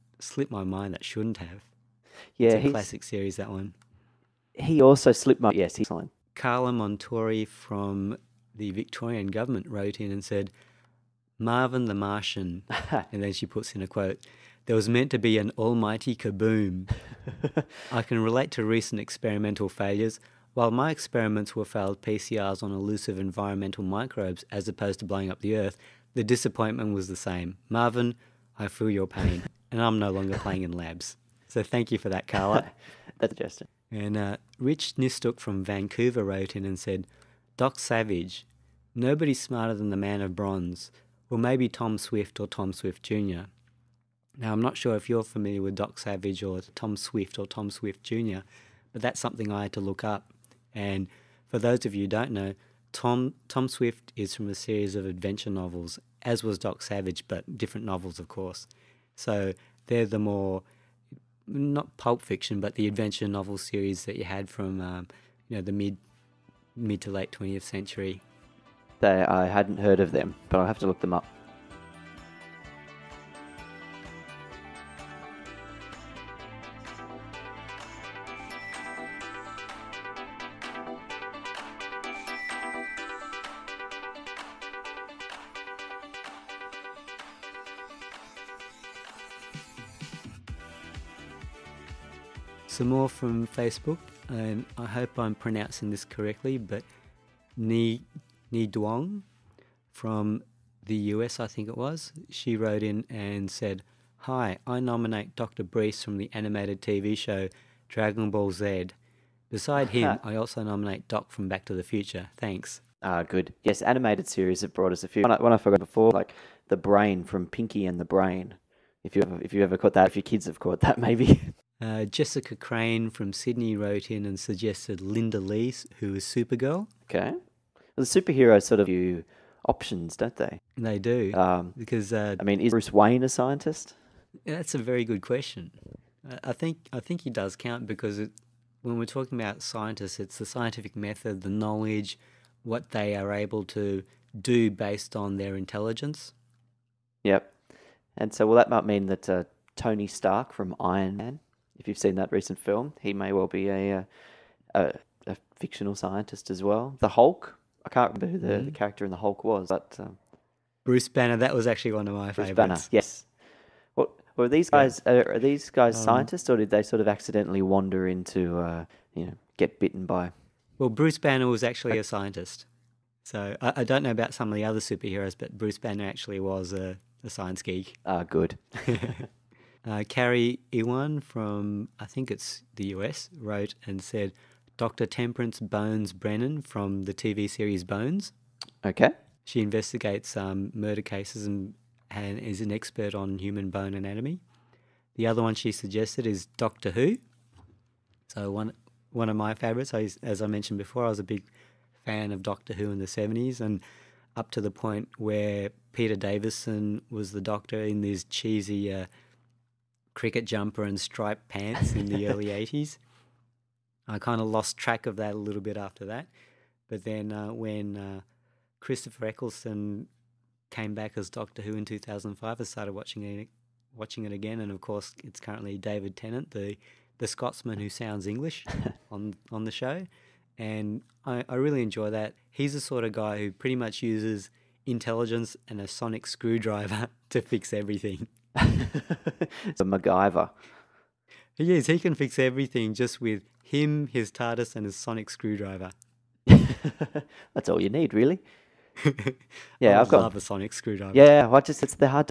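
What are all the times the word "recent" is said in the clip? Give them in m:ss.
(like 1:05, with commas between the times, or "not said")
0:18, 2:32.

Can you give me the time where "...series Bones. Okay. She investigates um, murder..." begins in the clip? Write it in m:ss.
3:07.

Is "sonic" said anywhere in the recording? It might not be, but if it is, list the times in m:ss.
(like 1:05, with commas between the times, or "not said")
3:55, 4:04, 4:10.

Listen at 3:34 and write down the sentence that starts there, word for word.
I kind of lost track of that a little bit after that.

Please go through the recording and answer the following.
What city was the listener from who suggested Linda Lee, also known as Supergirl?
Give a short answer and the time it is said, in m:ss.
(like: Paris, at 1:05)
Sydney, at 2:03.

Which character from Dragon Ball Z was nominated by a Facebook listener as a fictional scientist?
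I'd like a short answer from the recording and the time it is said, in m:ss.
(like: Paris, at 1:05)
Dr. Briefs, at 1:45.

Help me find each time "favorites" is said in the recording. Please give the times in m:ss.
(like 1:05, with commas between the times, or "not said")
2:42, 3:19.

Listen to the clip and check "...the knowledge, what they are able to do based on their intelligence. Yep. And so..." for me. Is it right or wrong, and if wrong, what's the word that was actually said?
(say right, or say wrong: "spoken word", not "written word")
right.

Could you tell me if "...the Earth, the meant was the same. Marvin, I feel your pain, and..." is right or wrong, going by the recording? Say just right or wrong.
wrong.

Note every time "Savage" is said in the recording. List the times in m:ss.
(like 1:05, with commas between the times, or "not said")
0:37, 0:45, 0:56.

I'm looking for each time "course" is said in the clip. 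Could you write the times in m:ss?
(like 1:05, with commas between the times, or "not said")
0:58, 3:44.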